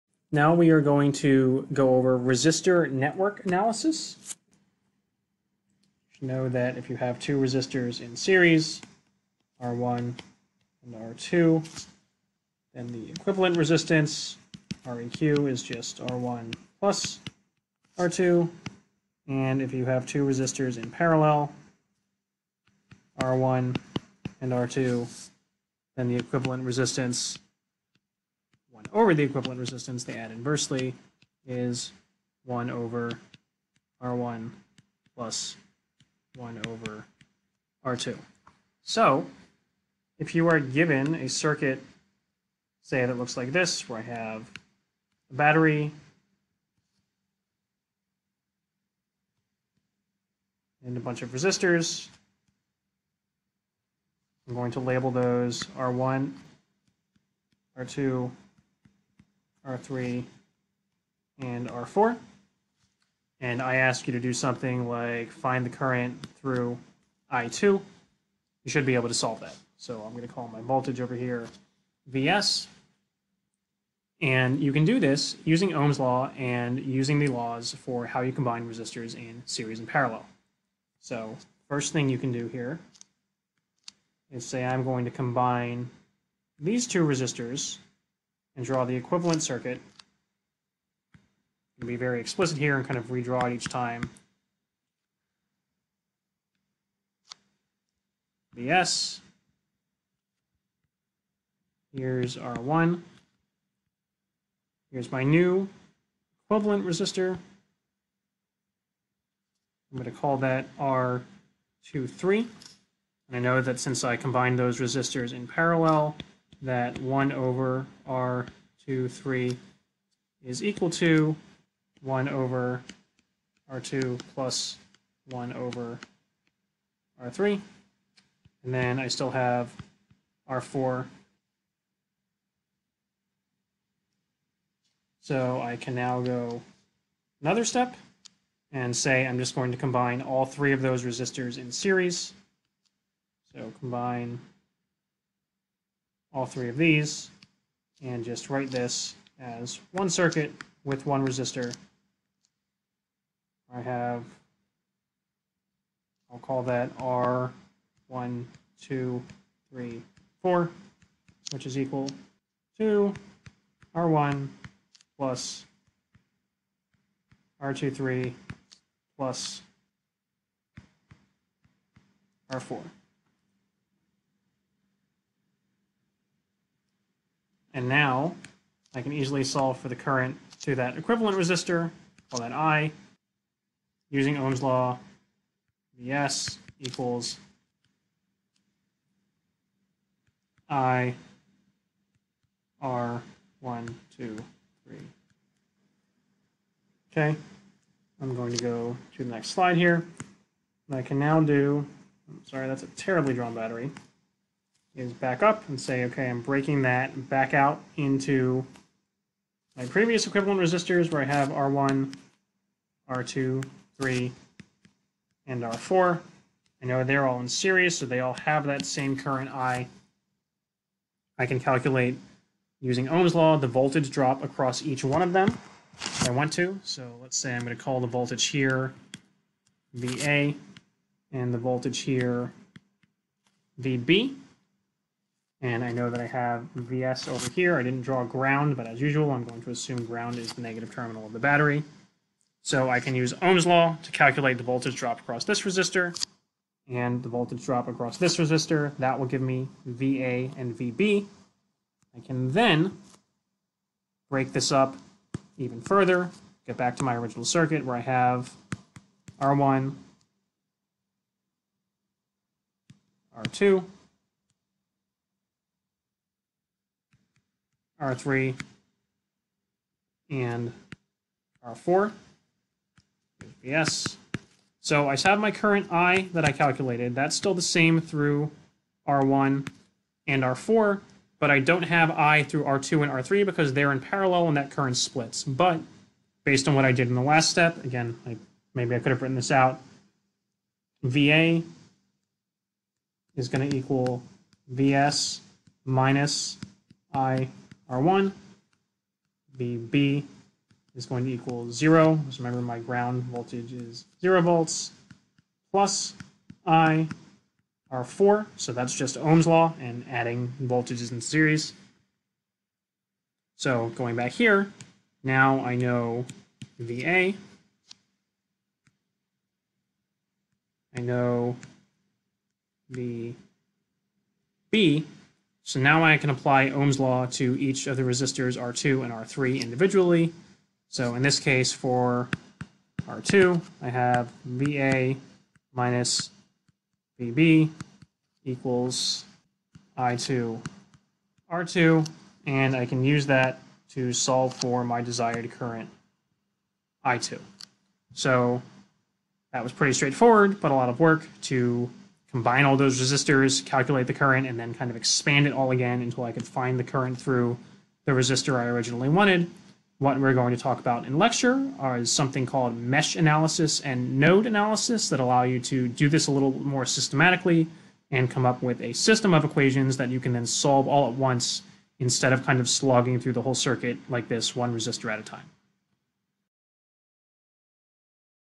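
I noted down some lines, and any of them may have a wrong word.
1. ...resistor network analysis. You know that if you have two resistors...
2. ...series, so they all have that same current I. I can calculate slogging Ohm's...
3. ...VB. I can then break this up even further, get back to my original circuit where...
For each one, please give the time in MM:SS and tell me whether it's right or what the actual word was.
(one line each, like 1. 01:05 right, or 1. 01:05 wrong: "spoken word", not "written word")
1. 00:02 right
2. 03:37 wrong: "using", not "slogging"
3. 04:10 right.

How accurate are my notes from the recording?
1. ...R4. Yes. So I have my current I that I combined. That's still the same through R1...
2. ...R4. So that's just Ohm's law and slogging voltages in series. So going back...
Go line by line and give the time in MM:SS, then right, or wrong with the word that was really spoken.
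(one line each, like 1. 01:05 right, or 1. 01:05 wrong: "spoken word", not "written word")
1. 04:31 wrong: "calculated", not "combined"
2. 05:07 wrong: "adding", not "slogging".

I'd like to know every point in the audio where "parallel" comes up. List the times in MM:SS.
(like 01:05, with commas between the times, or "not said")
00:20, 01:19, 01:55, 04:43.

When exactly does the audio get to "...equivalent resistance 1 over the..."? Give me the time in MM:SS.
00:26.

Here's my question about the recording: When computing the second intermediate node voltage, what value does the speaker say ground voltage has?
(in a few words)
0 volts.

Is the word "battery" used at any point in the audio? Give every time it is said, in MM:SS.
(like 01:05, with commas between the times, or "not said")
00:45, 03:23, 04:01.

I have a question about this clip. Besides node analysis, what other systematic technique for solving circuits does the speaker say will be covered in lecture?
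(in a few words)
mesh analysis.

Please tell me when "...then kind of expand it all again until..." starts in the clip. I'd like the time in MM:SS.
05:54.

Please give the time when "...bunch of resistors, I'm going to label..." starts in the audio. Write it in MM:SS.
00:50.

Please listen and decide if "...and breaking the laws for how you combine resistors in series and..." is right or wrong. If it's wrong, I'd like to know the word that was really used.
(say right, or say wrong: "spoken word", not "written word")
wrong: "using", not "breaking".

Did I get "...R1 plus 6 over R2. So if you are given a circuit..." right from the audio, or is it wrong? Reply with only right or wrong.
wrong.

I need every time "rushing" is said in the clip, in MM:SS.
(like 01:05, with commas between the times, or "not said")
not said.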